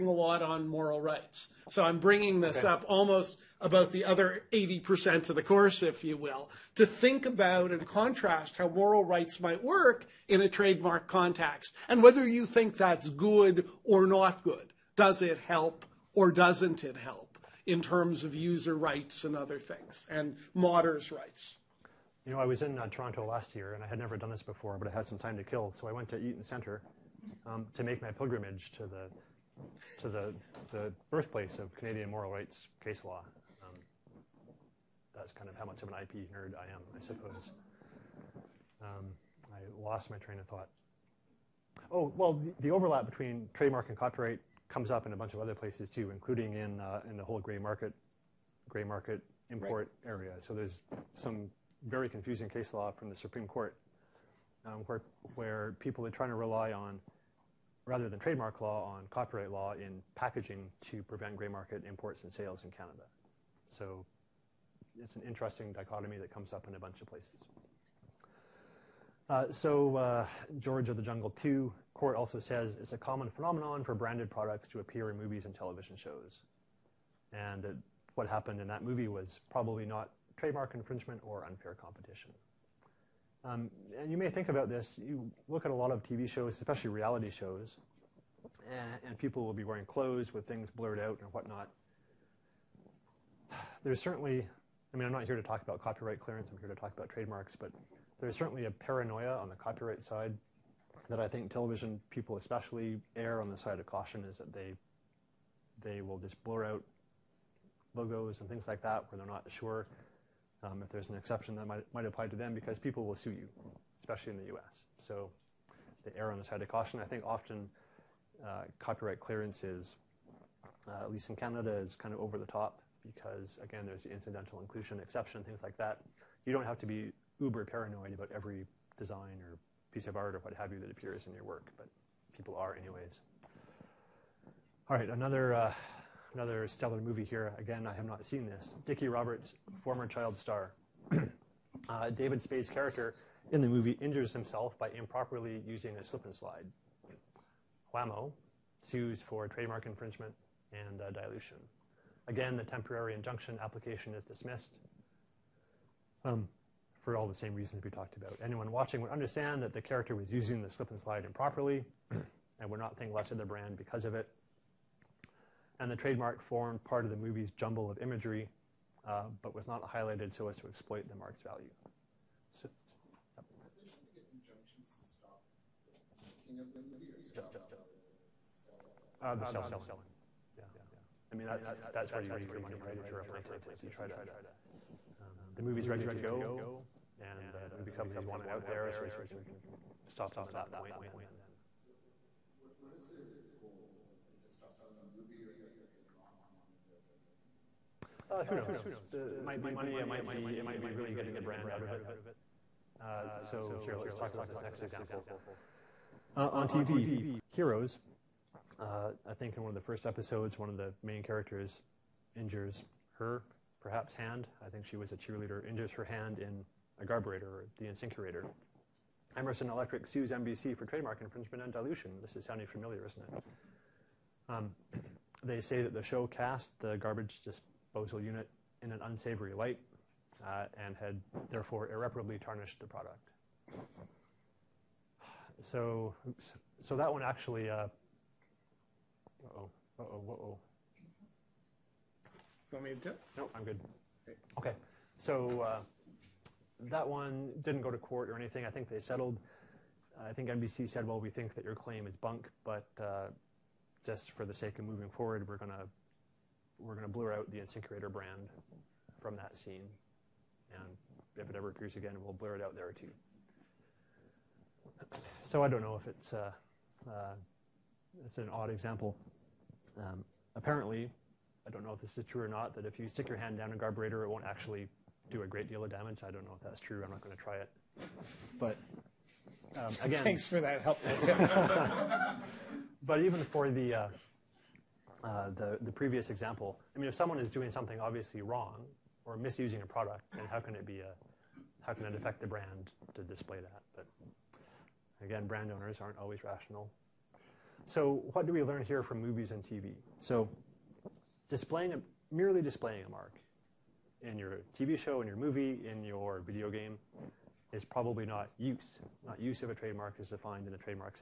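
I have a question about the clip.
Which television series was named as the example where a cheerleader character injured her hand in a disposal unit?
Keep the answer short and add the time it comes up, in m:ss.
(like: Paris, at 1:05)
Heroes, at 3:27.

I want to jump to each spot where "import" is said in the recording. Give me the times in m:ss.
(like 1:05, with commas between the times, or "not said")
0:49, 1:01.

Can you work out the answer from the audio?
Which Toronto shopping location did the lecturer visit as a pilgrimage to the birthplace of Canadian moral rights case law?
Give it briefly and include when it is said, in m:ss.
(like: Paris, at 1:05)
Eaton Center, at 0:26.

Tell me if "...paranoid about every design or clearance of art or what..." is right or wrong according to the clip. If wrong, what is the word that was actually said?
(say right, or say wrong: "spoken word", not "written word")
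wrong: "piece", not "clearance".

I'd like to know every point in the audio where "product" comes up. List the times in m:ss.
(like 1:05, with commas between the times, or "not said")
1:14, 3:52, 4:49.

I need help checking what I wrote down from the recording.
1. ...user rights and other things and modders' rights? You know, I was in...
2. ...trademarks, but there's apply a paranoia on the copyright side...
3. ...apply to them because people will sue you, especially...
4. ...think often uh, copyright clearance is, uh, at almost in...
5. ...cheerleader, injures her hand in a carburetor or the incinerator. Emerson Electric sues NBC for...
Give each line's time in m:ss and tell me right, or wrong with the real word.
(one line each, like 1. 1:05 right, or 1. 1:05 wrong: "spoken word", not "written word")
1. 0:18 right
2. 1:37 wrong: "certainly", not "apply"
3. 1:52 right
4. 1:57 wrong: "least", not "almost"
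5. 3:35 right.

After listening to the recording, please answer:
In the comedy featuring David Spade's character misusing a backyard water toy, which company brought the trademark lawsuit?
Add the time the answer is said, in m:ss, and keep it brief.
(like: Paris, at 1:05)
Whammo, at 2:27.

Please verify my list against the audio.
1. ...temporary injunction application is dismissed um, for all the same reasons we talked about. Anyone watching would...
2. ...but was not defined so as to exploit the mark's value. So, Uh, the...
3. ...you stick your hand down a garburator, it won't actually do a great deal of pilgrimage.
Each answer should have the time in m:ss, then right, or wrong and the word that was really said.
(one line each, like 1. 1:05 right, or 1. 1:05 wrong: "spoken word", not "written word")
1. 2:32 right
2. 2:49 wrong: "highlighted", not "defined"
3. 4:32 wrong: "damage", not "pilgrimage".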